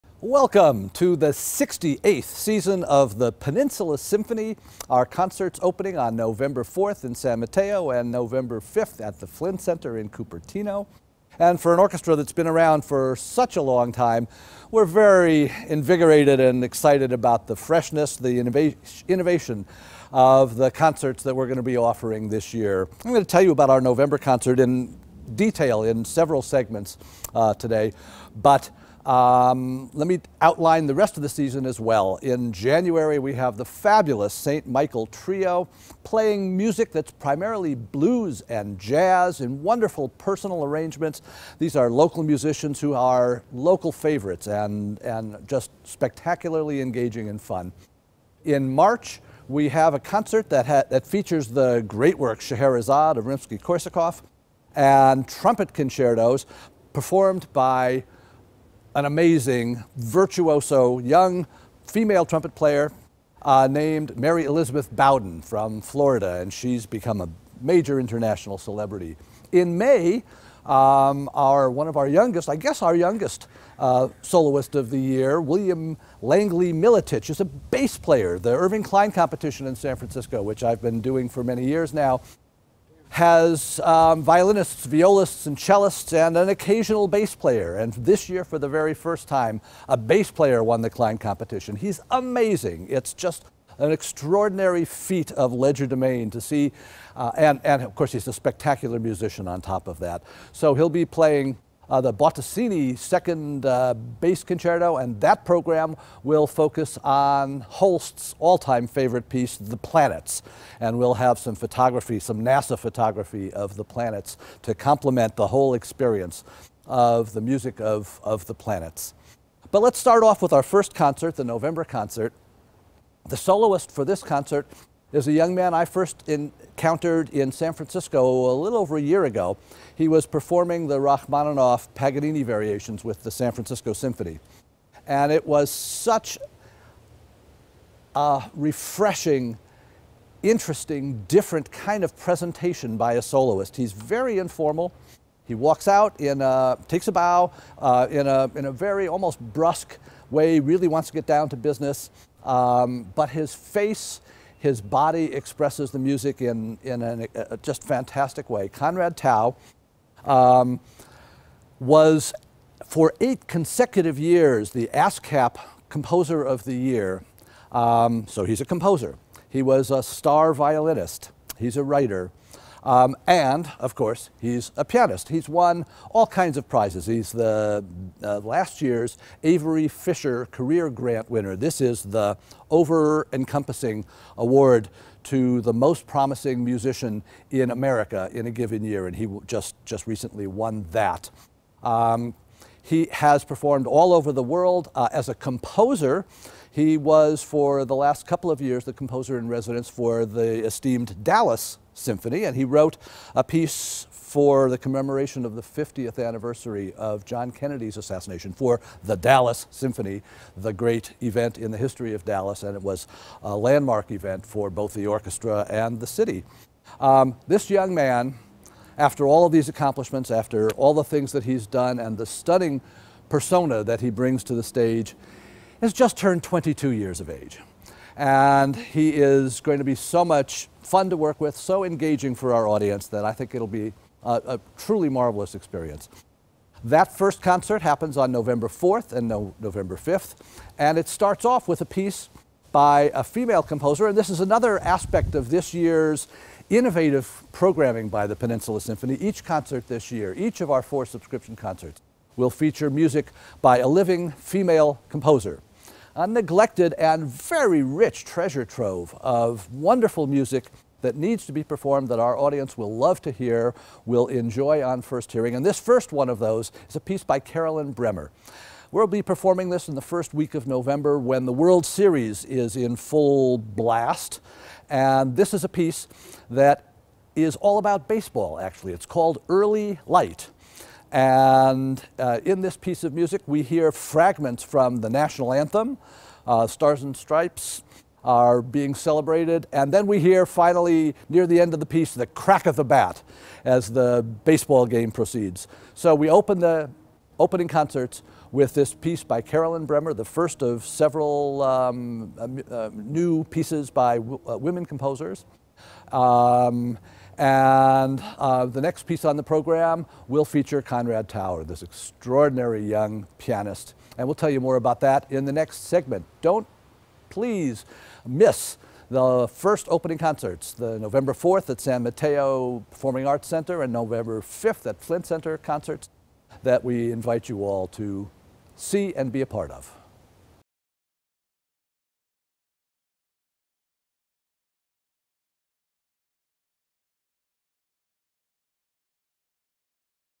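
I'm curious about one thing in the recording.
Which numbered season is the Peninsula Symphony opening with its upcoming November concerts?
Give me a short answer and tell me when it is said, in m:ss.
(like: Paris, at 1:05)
68th, at 0:01.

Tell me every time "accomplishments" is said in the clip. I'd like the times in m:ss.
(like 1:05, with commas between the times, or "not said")
3:39.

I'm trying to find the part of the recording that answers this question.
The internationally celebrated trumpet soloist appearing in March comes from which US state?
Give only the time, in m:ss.
1:05.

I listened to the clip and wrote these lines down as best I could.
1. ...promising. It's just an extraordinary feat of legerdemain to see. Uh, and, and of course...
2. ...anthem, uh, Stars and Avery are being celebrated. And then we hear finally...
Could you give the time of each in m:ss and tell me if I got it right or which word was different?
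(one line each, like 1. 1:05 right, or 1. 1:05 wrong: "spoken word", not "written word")
1. 1:32 wrong: "amazing", not "promising"
2. 4:45 wrong: "Stripes", not "Avery".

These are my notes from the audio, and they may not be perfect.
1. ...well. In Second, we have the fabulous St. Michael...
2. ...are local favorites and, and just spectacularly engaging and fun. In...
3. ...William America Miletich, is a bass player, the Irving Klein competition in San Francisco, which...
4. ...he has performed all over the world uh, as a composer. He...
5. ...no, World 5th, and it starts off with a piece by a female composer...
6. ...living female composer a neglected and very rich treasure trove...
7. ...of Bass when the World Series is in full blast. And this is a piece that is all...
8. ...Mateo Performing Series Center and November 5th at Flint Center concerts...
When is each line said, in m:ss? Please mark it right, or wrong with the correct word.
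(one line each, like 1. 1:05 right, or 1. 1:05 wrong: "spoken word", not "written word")
1. 0:31 wrong: "January", not "Second"
2. 0:42 right
3. 1:15 wrong: "Langlie", not "America"
4. 3:12 right
5. 3:59 wrong: "November", not "World"
6. 4:13 right
7. 4:30 wrong: "November", not "Bass"
8. 5:22 wrong: "Arts", not "Series".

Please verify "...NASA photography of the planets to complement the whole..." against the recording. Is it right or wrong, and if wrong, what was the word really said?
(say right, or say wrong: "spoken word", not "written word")
right.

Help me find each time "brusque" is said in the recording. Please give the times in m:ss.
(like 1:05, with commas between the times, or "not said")
2:29.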